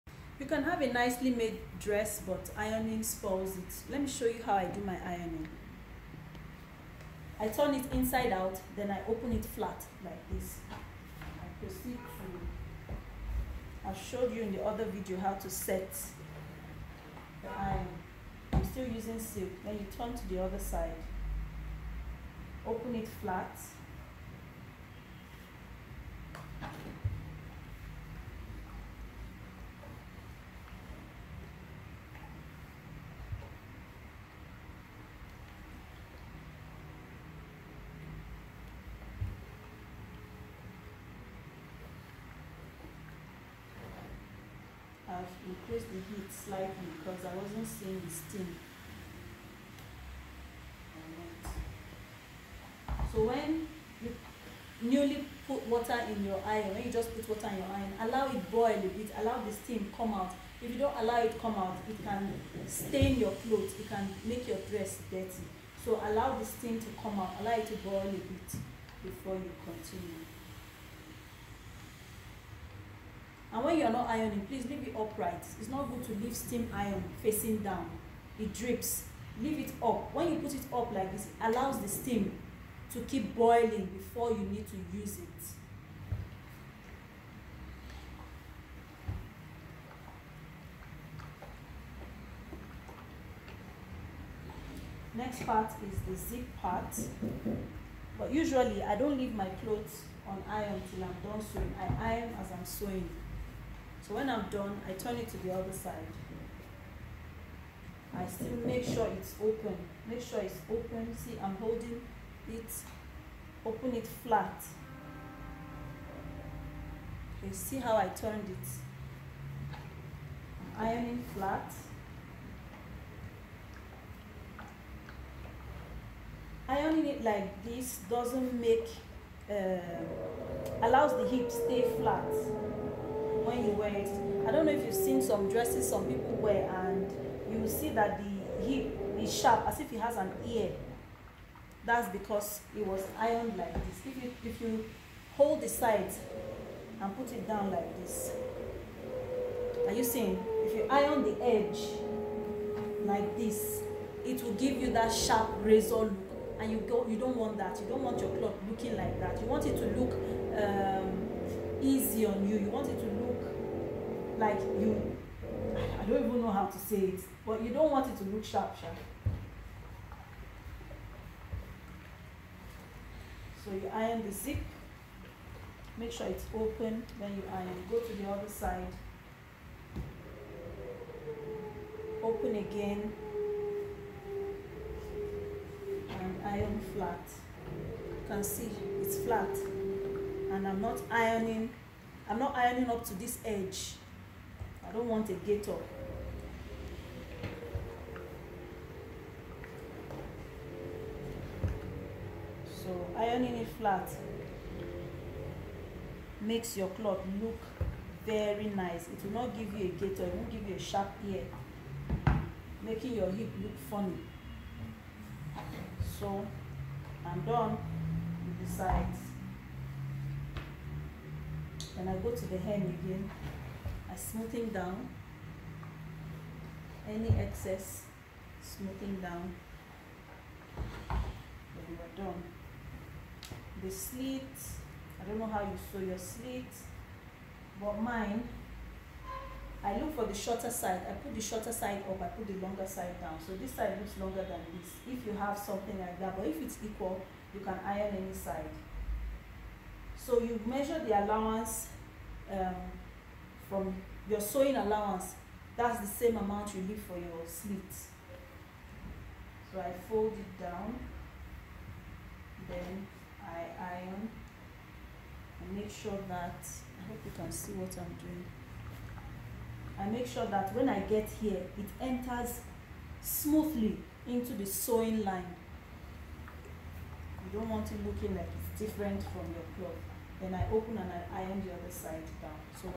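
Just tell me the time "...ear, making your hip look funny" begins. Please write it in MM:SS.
03:31.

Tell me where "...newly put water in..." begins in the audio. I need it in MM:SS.
00:54.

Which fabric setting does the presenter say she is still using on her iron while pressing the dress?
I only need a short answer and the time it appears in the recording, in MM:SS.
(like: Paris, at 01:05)
silk, at 00:19.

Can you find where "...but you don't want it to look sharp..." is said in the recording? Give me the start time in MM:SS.
02:47.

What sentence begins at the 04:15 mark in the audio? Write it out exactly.
That's the same amount you leave for your slit.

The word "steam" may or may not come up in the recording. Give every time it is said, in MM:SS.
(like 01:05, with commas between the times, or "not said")
00:48, 00:59, 01:06, 01:16, 01:21.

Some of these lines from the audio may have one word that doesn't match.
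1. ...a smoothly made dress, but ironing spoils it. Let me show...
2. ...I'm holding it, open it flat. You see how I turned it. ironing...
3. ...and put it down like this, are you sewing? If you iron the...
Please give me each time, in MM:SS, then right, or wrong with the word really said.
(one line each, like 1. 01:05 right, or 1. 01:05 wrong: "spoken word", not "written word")
1. 00:00 wrong: "nicely", not "smoothly"
2. 01:51 right
3. 02:27 wrong: "seeing", not "sewing".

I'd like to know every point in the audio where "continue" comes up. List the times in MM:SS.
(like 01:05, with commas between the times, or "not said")
01:09.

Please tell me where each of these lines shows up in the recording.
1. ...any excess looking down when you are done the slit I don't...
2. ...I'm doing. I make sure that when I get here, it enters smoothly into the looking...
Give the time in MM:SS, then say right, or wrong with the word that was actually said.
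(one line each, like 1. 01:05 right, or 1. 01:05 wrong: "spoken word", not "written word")
1. 03:47 wrong: "smoothing", not "looking"
2. 04:27 wrong: "sewing", not "looking".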